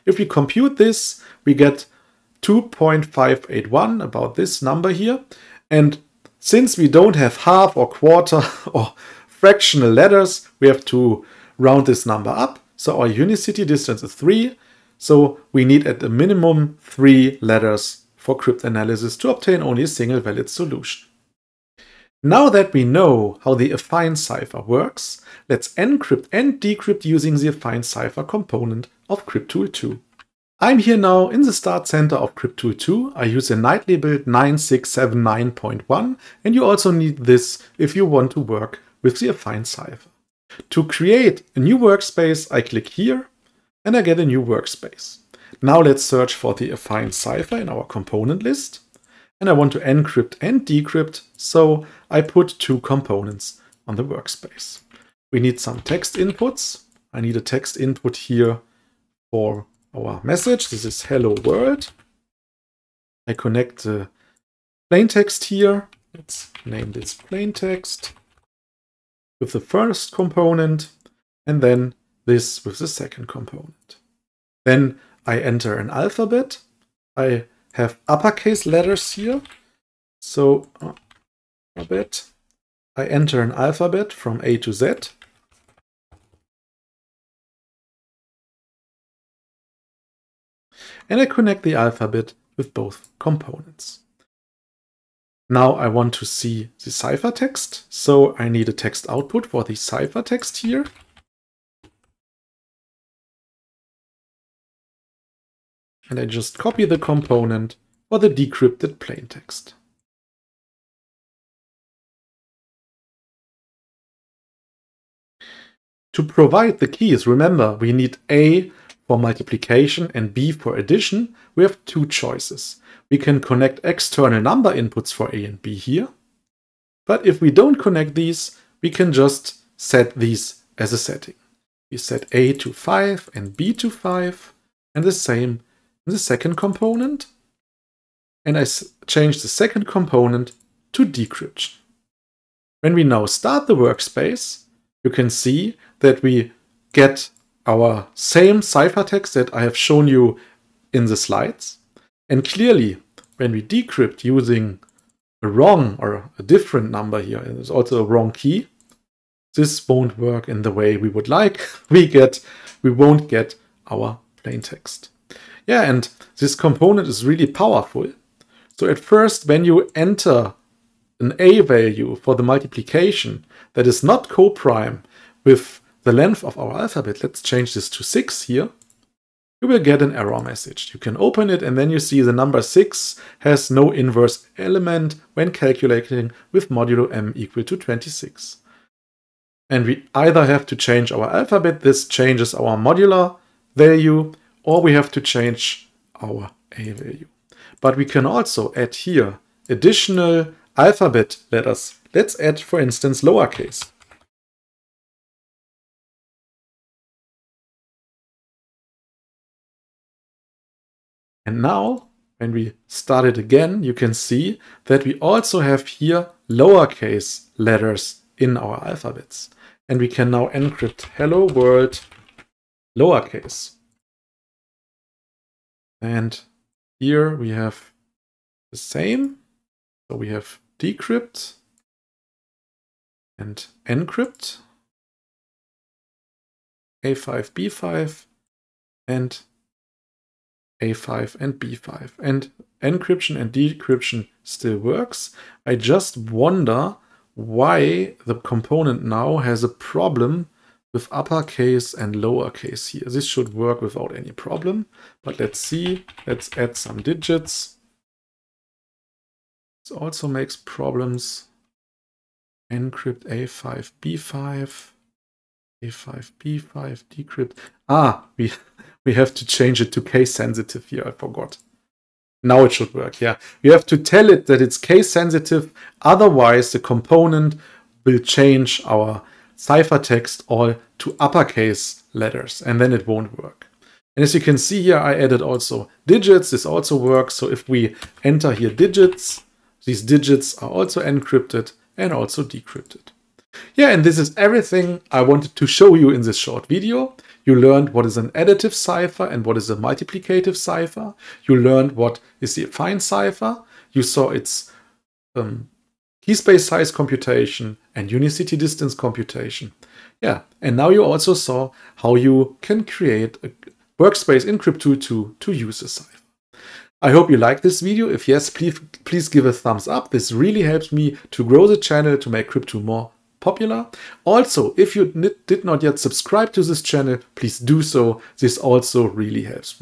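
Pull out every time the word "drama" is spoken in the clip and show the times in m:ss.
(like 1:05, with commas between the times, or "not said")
not said.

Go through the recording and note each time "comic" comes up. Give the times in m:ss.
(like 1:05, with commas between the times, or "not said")
not said.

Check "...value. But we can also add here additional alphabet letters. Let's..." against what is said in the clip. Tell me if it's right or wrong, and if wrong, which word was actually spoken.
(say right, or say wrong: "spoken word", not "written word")
right.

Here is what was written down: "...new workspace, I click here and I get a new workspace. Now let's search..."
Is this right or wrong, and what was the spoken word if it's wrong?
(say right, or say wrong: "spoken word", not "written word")
right.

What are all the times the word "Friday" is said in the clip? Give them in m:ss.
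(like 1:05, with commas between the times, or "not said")
not said.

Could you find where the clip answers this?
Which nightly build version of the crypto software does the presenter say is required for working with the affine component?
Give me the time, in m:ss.
0:34.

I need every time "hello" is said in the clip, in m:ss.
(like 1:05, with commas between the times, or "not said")
1:01, 3:41.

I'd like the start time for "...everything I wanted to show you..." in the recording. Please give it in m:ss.
4:54.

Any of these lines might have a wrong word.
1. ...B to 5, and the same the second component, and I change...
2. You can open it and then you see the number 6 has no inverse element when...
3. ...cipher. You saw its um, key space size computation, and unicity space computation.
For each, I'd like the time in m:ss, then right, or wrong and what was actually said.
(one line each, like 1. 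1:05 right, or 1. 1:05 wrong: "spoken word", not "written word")
1. 2:13 right
2. 3:00 right
3. 5:03 wrong: "distance", not "space".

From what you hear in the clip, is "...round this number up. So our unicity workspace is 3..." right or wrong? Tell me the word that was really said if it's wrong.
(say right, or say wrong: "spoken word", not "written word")
wrong: "distance", not "workspace".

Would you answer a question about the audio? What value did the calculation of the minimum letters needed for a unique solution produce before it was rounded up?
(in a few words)
2.581.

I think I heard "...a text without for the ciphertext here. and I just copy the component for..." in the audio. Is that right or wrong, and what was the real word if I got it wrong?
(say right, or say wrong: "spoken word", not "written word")
wrong: "output", not "without".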